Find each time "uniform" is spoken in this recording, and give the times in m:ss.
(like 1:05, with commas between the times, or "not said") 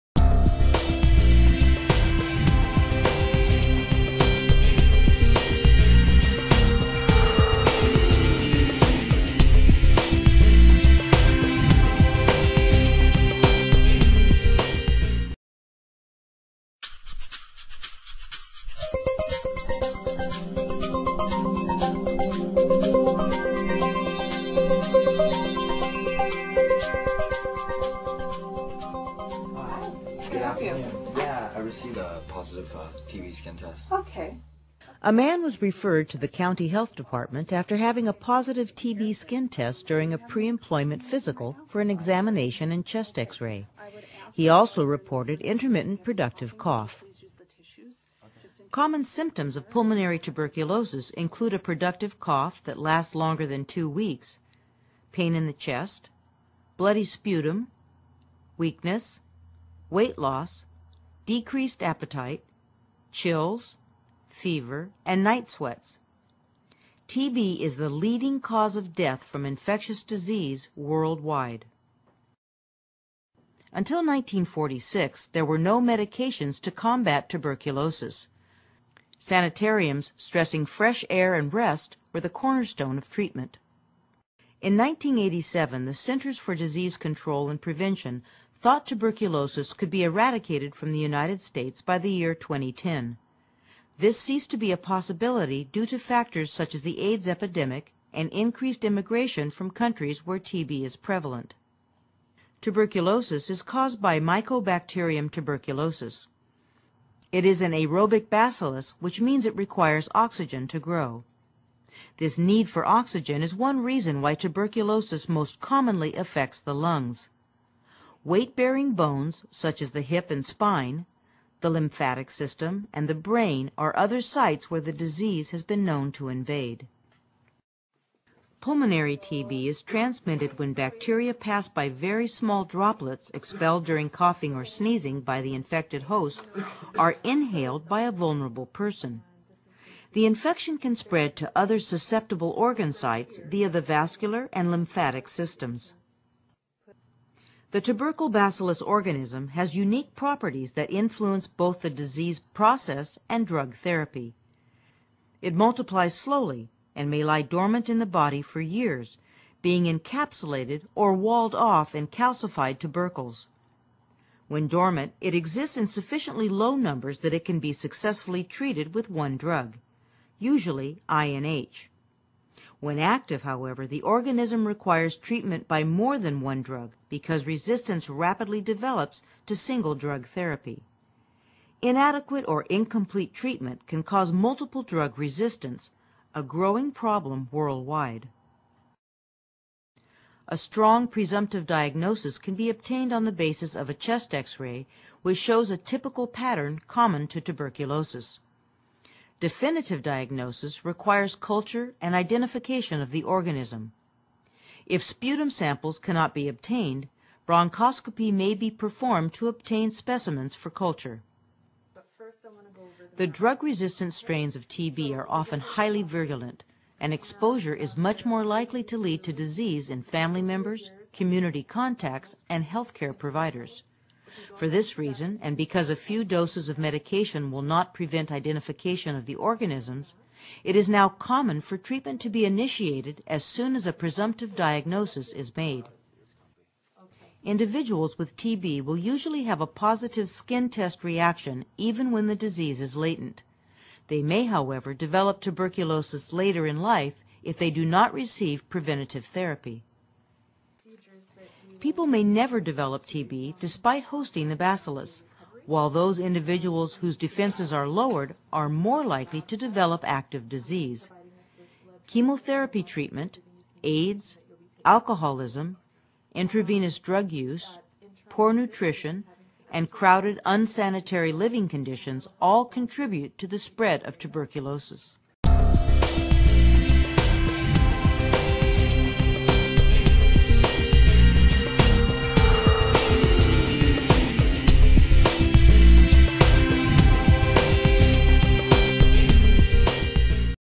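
not said.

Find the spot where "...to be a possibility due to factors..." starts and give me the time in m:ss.
1:34.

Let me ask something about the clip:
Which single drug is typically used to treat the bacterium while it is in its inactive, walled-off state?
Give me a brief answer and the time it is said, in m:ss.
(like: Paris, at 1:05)
INH, at 2:51.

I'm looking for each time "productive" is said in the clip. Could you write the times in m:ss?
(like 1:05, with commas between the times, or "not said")
0:46, 0:51.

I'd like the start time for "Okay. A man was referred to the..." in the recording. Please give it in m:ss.
0:33.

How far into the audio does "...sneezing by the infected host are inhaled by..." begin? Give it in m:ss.
2:14.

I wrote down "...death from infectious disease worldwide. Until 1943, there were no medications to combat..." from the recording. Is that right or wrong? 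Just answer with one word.
wrong.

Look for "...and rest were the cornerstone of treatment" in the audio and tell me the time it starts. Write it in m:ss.
1:21.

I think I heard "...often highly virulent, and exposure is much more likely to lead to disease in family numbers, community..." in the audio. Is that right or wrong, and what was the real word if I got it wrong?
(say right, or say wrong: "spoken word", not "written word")
wrong: "members", not "numbers".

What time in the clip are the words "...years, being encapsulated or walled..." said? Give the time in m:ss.
2:38.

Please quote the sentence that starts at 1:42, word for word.
Tuberculosis is caused by Mycobacterium tuberculosis.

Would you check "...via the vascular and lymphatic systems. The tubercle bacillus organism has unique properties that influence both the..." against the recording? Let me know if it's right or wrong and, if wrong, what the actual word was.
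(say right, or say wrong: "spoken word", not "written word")
right.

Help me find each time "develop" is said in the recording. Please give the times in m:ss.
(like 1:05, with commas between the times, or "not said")
2:58, 4:04, 4:12, 4:19.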